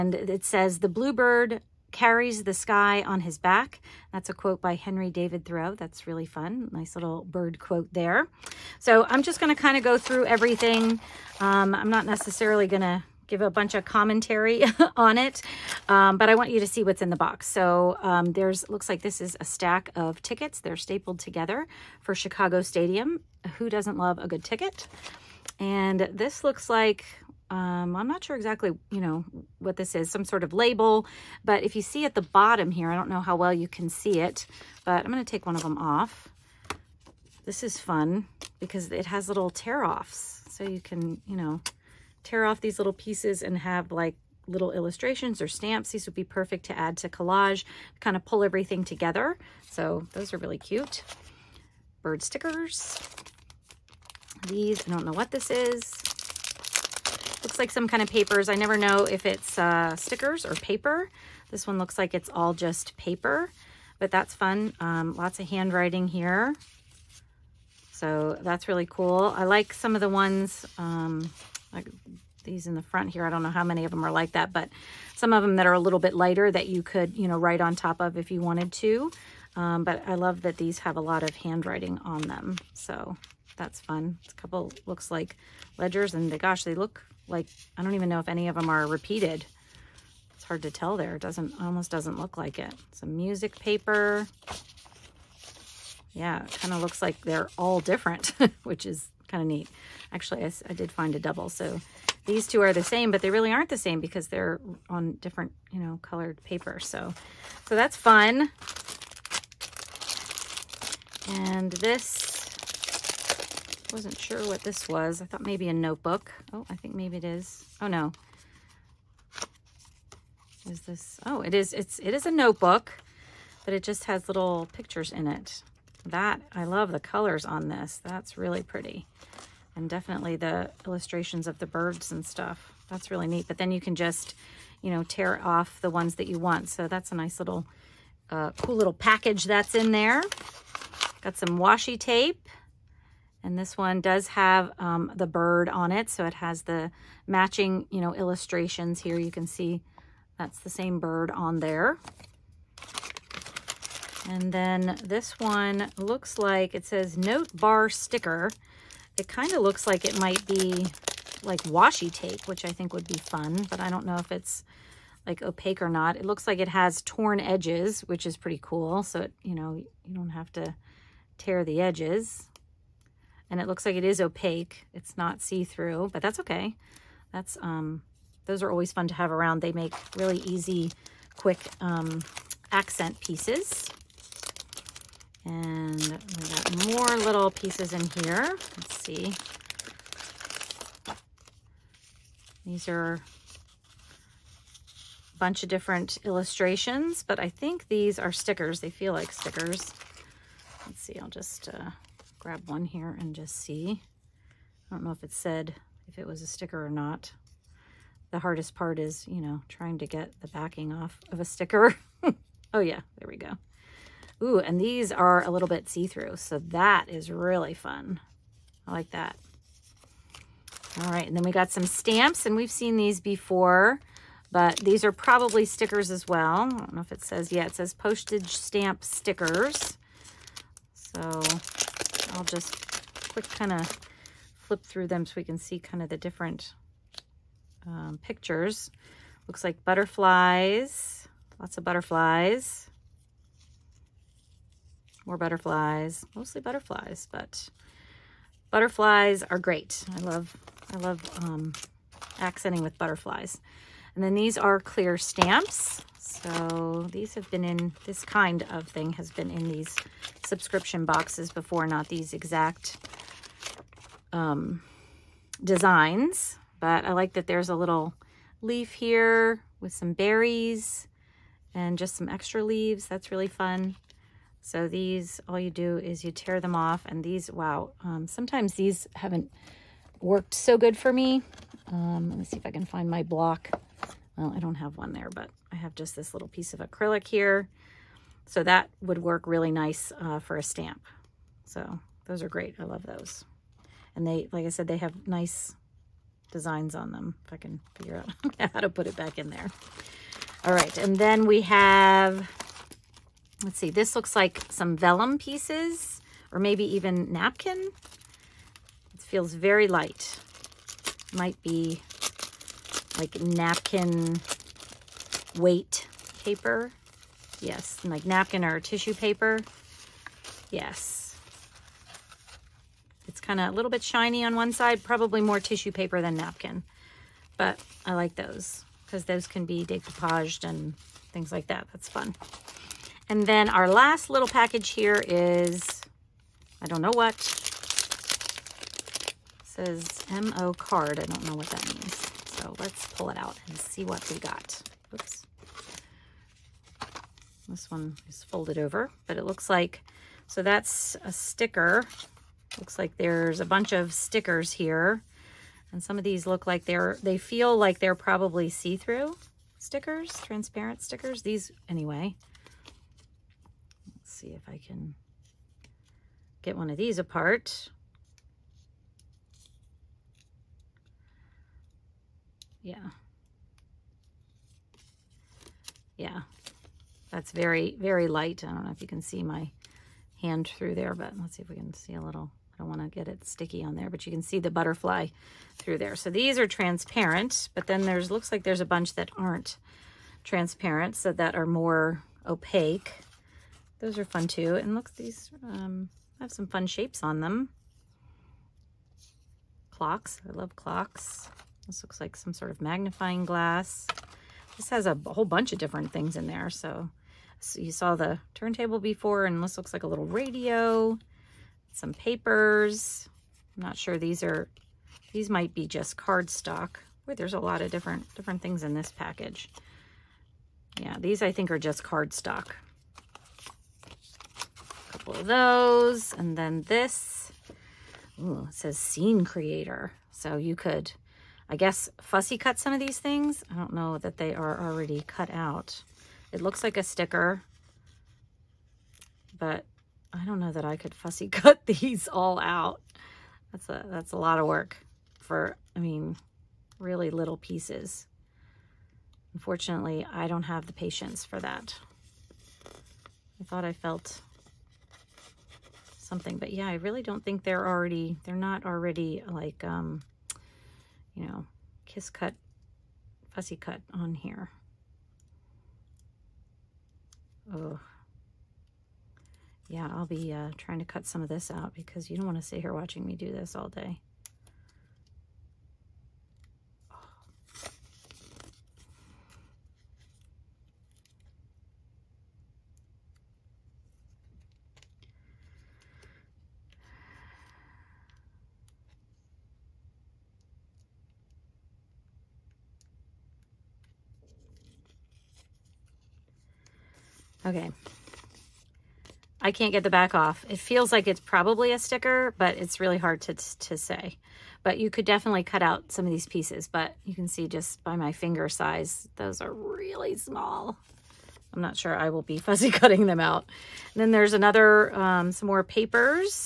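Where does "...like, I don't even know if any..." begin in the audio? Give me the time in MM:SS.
01:27.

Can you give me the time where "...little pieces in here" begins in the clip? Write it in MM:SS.
03:07.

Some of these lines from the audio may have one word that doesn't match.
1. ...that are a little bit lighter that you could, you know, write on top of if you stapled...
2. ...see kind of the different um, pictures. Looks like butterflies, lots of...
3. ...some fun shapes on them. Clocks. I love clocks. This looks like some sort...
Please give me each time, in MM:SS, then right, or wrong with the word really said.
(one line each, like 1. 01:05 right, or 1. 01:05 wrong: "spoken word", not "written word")
1. 01:15 wrong: "wanted", not "stapled"
2. 03:55 right
3. 06:36 right.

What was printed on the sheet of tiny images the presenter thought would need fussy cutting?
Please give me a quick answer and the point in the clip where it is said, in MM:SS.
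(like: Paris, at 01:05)
Scene creator, at 07:08.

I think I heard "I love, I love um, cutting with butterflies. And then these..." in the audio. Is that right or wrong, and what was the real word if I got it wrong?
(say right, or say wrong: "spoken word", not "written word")
wrong: "accenting", not "cutting".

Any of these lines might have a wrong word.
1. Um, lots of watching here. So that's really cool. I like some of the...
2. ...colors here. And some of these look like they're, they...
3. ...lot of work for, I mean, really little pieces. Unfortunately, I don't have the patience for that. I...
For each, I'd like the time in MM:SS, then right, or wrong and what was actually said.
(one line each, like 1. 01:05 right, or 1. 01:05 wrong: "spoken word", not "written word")
1. 01:04 wrong: "handwriting", not "watching"
2. 05:54 wrong: "stickers", not "colors"
3. 07:24 right.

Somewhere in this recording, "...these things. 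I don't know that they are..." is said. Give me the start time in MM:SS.
07:13.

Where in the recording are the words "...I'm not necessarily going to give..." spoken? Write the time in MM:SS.
00:11.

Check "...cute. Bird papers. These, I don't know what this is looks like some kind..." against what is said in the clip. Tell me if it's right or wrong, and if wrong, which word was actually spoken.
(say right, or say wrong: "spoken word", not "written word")
wrong: "stickers", not "papers".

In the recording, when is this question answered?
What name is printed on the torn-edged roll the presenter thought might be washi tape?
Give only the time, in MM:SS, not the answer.
02:37.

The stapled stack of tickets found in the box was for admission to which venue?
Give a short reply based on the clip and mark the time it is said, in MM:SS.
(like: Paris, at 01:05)
Chicago Stadium, at 00:22.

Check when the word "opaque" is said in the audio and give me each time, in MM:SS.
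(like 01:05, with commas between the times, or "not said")
02:45, 02:54, 06:32.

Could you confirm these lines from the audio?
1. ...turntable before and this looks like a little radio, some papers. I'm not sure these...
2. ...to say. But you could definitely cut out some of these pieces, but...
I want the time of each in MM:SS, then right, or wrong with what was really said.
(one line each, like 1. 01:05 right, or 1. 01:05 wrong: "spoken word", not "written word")
1. 06:48 right
2. 08:23 right.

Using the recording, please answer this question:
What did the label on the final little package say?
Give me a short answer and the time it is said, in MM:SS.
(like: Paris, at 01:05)
MO card, at 05:40.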